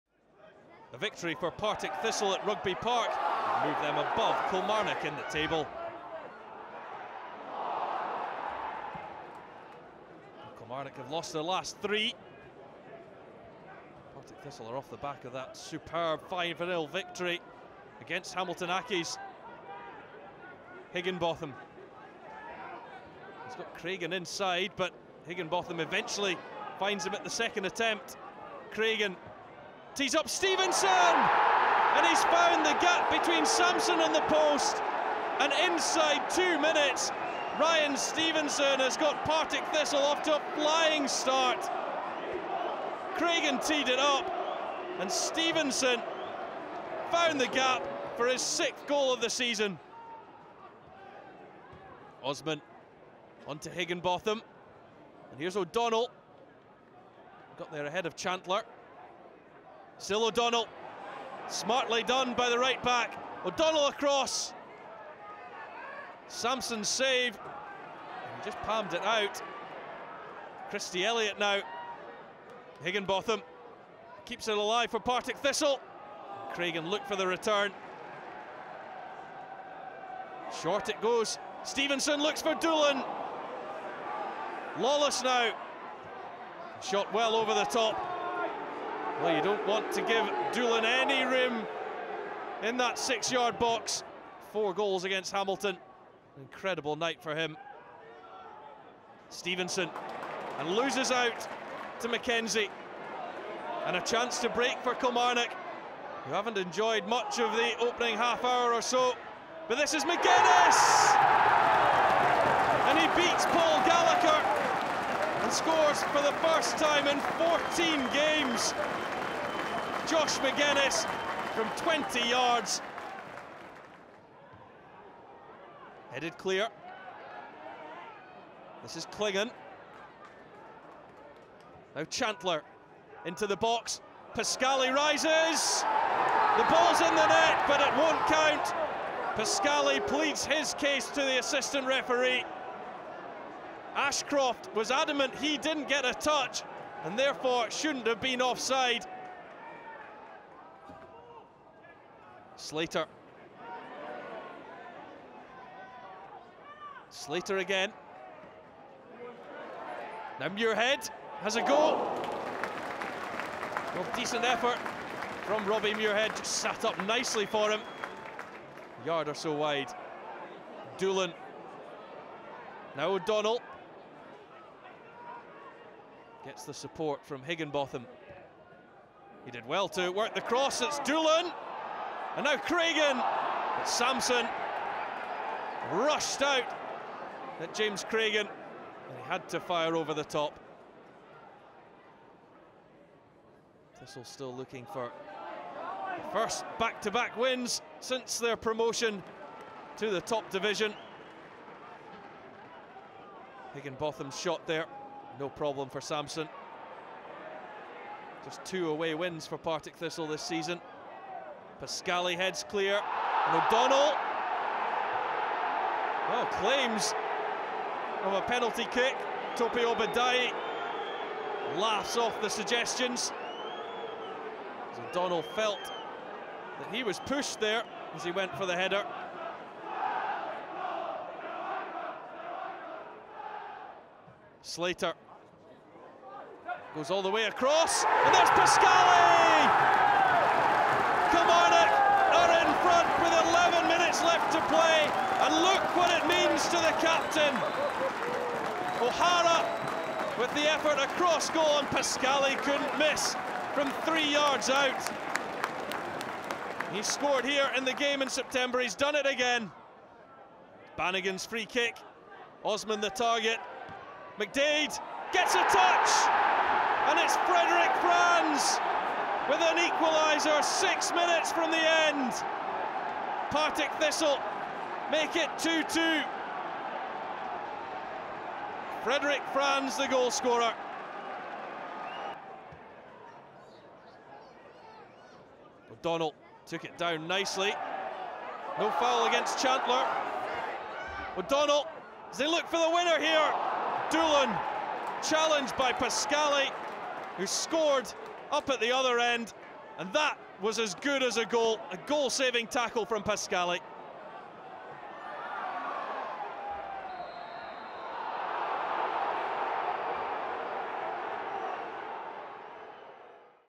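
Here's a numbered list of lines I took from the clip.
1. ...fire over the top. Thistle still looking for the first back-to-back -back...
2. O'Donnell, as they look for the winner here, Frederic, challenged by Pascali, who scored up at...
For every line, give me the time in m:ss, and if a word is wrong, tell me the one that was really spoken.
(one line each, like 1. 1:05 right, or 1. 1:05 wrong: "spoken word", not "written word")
1. 3:09 right
2. 4:51 wrong: "Doolan", not "Frederic".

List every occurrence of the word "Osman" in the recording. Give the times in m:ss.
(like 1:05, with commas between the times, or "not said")
0:52, 4:22.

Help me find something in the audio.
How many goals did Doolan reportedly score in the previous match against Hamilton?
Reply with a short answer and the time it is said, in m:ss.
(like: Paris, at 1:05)
4, at 1:34.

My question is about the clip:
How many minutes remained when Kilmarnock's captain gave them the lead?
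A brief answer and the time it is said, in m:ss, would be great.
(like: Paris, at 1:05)
11, at 4:03.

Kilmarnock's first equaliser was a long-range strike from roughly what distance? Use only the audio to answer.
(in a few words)
20 yards.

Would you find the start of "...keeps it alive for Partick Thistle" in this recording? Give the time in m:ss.
1:14.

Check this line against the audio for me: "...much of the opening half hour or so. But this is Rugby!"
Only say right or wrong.
wrong.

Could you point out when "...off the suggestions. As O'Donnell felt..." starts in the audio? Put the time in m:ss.
3:42.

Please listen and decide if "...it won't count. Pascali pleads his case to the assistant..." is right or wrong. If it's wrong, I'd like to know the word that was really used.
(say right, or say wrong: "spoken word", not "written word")
right.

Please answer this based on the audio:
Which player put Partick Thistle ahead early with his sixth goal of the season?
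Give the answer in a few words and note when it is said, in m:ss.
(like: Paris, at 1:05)
Ryan Stevenson, at 0:37.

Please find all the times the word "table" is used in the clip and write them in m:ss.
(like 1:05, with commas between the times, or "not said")
0:05.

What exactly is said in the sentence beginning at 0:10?
Kilmarnock have lost their last three.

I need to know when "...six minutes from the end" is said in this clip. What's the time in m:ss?
4:30.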